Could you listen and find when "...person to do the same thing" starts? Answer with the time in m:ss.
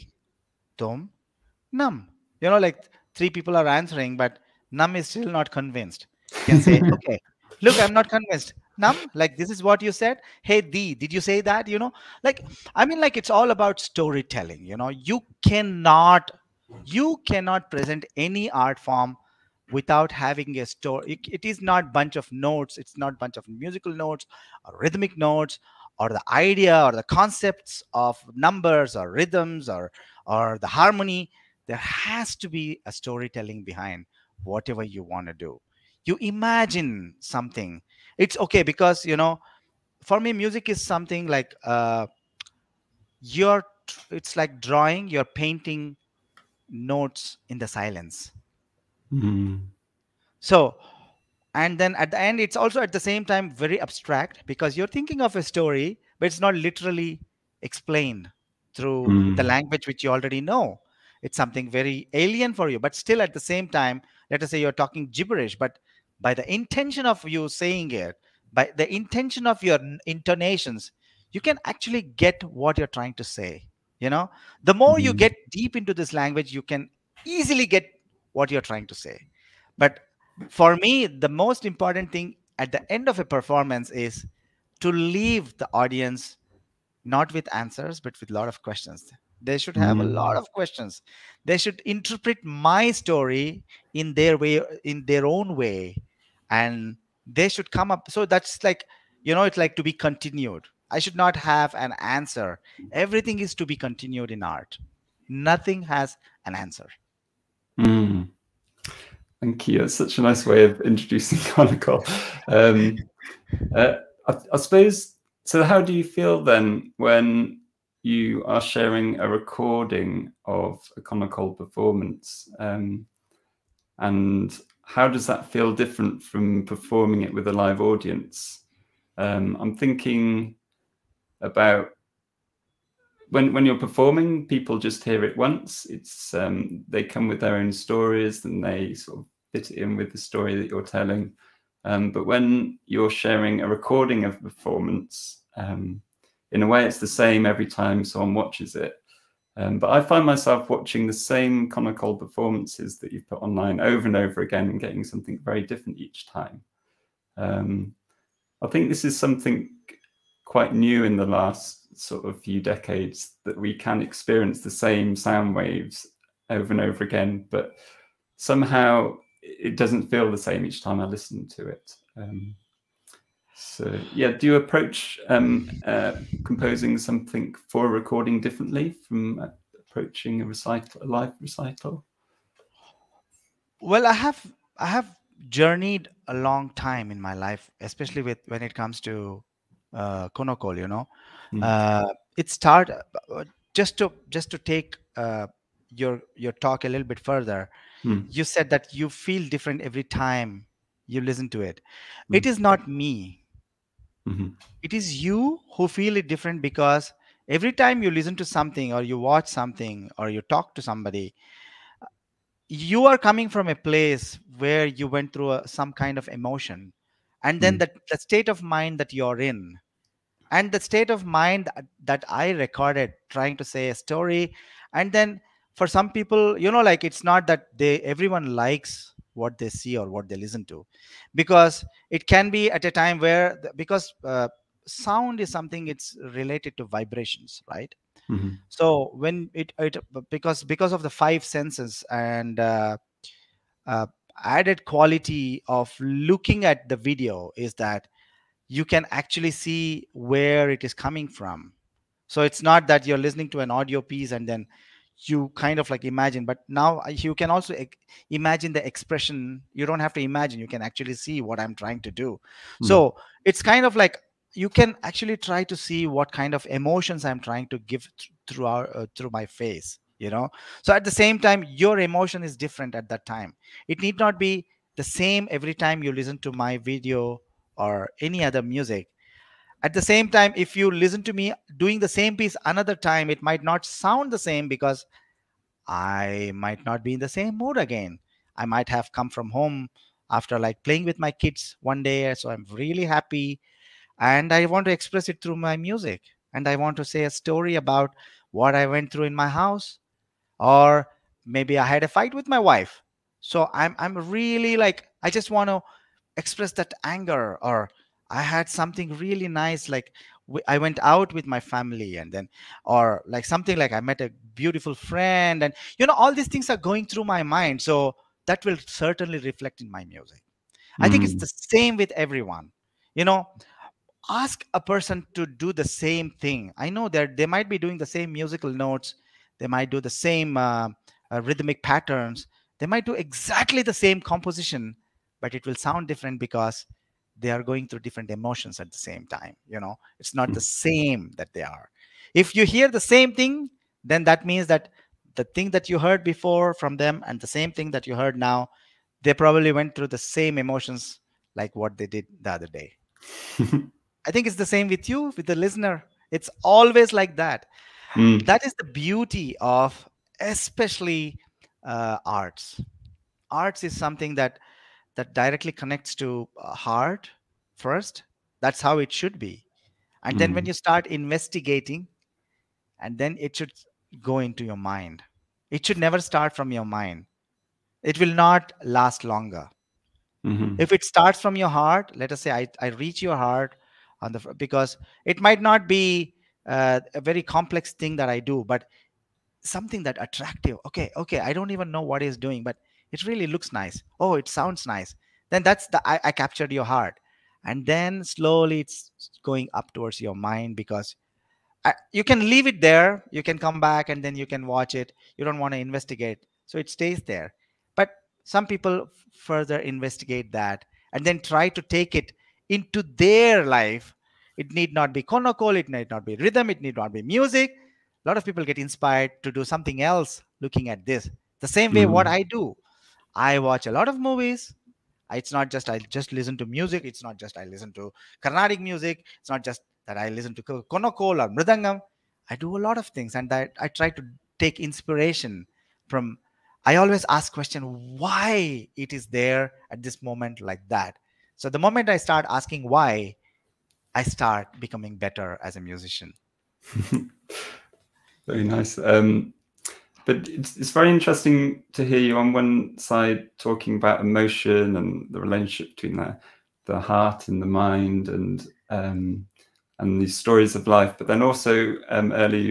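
5:24.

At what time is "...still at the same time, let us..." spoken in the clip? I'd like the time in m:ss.
1:02.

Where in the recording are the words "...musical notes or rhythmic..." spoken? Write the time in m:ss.
0:23.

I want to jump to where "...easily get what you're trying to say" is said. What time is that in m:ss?
1:17.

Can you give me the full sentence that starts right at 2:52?
Um, so yeah, do you approach um, uh, composing something for a recording differently from approaching a recital, a live recital?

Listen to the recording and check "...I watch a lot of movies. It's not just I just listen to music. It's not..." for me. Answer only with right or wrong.
right.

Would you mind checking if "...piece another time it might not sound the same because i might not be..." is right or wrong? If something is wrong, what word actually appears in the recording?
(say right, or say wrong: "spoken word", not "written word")
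right.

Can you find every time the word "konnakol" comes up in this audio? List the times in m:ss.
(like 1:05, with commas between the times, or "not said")
1:51, 2:01, 2:31, 3:10, 6:55, 7:10.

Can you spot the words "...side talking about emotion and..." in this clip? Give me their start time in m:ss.
7:32.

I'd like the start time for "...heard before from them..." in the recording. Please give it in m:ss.
5:45.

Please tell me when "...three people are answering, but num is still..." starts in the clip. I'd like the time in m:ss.
0:03.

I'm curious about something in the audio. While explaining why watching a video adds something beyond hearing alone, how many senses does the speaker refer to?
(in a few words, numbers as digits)
5.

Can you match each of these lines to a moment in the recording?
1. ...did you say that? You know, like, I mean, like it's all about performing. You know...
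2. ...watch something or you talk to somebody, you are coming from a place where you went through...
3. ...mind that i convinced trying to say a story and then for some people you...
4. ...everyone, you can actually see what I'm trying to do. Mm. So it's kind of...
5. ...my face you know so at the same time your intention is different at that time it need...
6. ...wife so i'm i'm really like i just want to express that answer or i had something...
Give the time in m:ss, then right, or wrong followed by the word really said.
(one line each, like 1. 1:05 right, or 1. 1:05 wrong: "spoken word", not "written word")
1. 0:10 wrong: "storytelling", not "performing"
2. 3:29 right
3. 3:41 wrong: "recorded", not "convinced"
4. 4:20 wrong: "imagine", not "everyone"
5. 4:29 wrong: "emotion", not "intention"
6. 5:02 wrong: "anger", not "answer".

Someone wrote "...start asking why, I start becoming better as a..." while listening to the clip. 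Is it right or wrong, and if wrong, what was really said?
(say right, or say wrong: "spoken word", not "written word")
right.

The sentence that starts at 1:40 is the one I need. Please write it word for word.
I should not have an answer.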